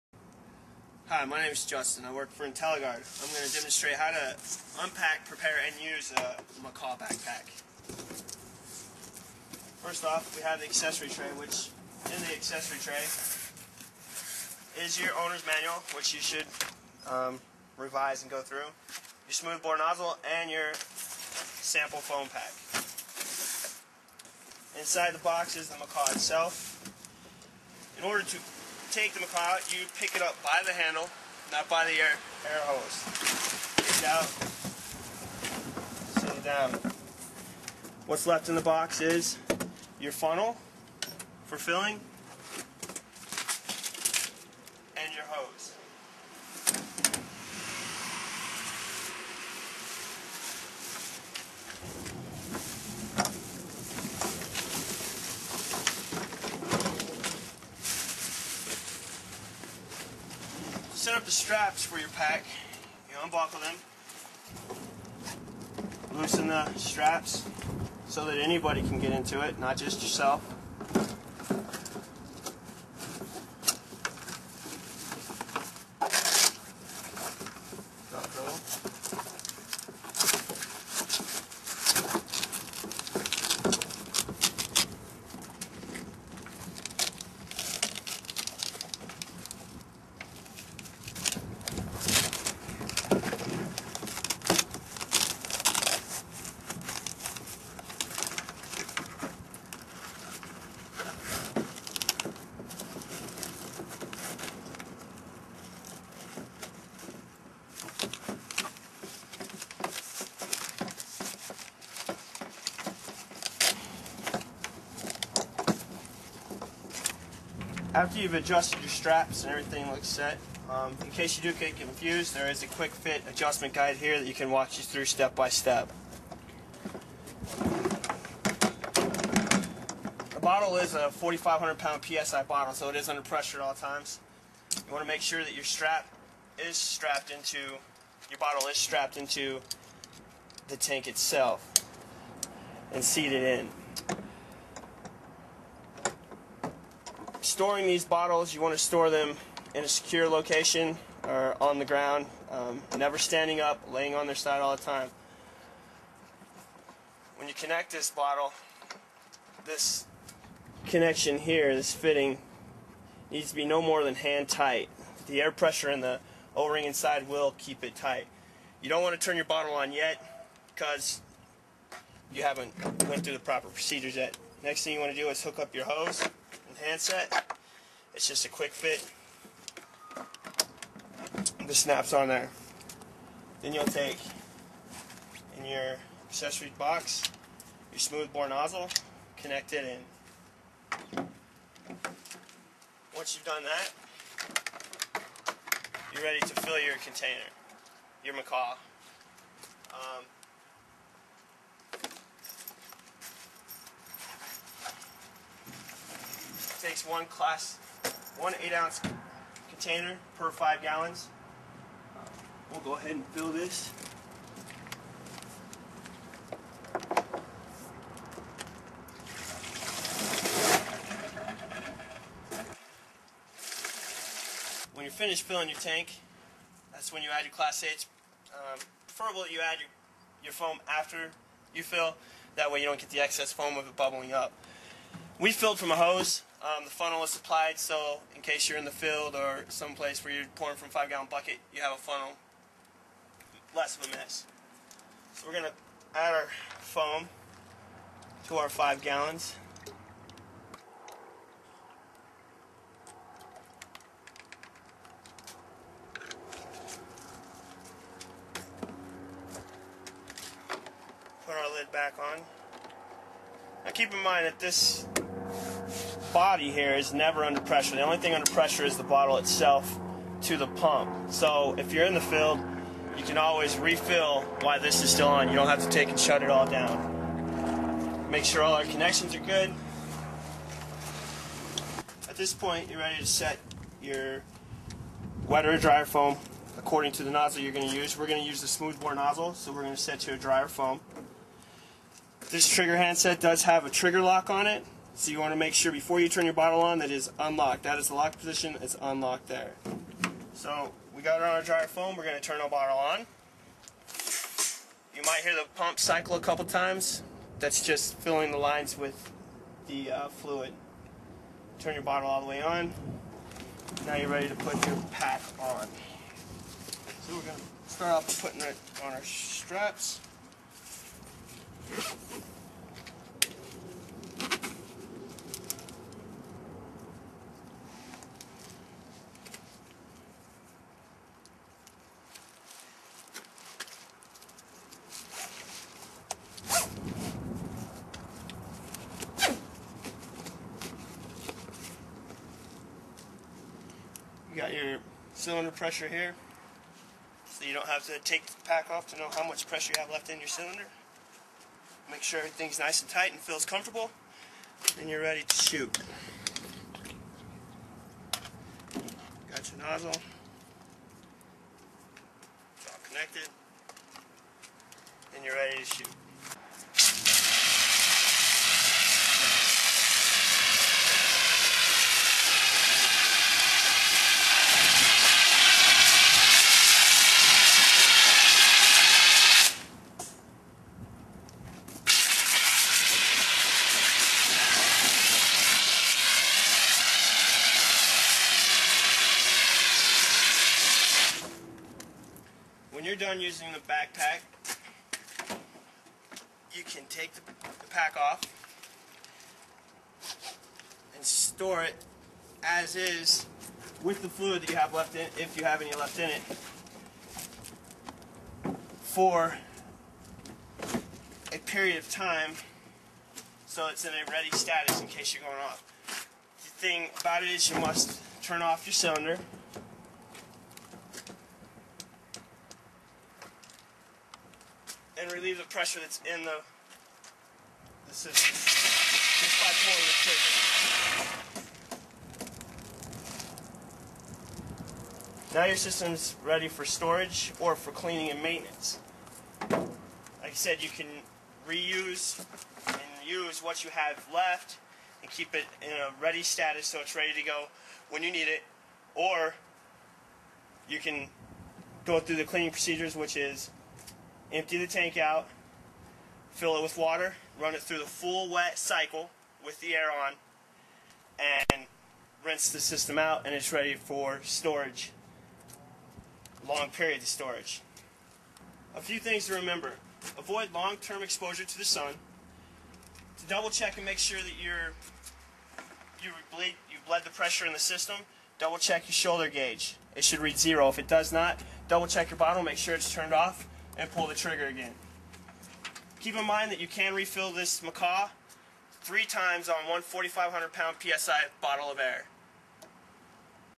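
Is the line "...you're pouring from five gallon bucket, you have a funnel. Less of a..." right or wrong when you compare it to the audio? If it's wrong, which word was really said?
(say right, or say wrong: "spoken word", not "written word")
right.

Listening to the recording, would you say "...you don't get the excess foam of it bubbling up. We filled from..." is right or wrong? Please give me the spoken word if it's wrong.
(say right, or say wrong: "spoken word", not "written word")
right.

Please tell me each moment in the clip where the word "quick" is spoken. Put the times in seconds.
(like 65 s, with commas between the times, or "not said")
122 s, 178 s.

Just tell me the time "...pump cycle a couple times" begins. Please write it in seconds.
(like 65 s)
305 s.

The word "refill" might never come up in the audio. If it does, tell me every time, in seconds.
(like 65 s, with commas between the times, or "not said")
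273 s, 487 s.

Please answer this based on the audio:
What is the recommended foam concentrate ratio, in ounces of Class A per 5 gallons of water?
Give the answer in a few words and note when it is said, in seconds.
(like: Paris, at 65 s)
8 ounces, at 208 s.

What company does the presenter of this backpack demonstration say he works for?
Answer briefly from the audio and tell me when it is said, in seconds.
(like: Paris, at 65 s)
Intelagard, at 2 s.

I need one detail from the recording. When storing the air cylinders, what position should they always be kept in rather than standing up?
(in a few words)
Laying on their side.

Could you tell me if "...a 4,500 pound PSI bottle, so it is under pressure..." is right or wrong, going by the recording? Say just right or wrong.
right.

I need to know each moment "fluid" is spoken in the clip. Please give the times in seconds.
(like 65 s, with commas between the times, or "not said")
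310 s, 404 s.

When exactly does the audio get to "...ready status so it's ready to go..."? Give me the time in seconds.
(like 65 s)
446 s.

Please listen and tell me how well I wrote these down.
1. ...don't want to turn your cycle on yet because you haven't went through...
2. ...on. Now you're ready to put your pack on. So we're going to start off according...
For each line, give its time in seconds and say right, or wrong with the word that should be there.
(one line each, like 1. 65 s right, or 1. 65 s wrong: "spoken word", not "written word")
1. 168 s wrong: "bottle", not "cycle"
2. 312 s wrong: "putting", not "according".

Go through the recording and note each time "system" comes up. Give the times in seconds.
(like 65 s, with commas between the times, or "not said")
428 s, 435 s, 462 s, 477 s.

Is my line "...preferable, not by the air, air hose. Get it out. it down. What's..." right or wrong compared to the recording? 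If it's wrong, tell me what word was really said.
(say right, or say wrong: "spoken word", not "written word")
wrong: "handle", not "preferable".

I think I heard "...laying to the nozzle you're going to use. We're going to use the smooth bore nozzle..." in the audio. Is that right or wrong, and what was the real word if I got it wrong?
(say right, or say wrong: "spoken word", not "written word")
wrong: "according", not "laying".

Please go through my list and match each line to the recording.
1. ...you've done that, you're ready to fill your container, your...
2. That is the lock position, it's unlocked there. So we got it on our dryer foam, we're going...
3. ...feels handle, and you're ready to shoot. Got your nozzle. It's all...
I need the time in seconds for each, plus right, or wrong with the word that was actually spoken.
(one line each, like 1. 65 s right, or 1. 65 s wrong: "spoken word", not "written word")
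1. 193 s right
2. 297 s right
3. 353 s wrong: "comfortable", not "handle".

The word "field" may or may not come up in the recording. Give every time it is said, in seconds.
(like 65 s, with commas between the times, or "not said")
238 s, 272 s.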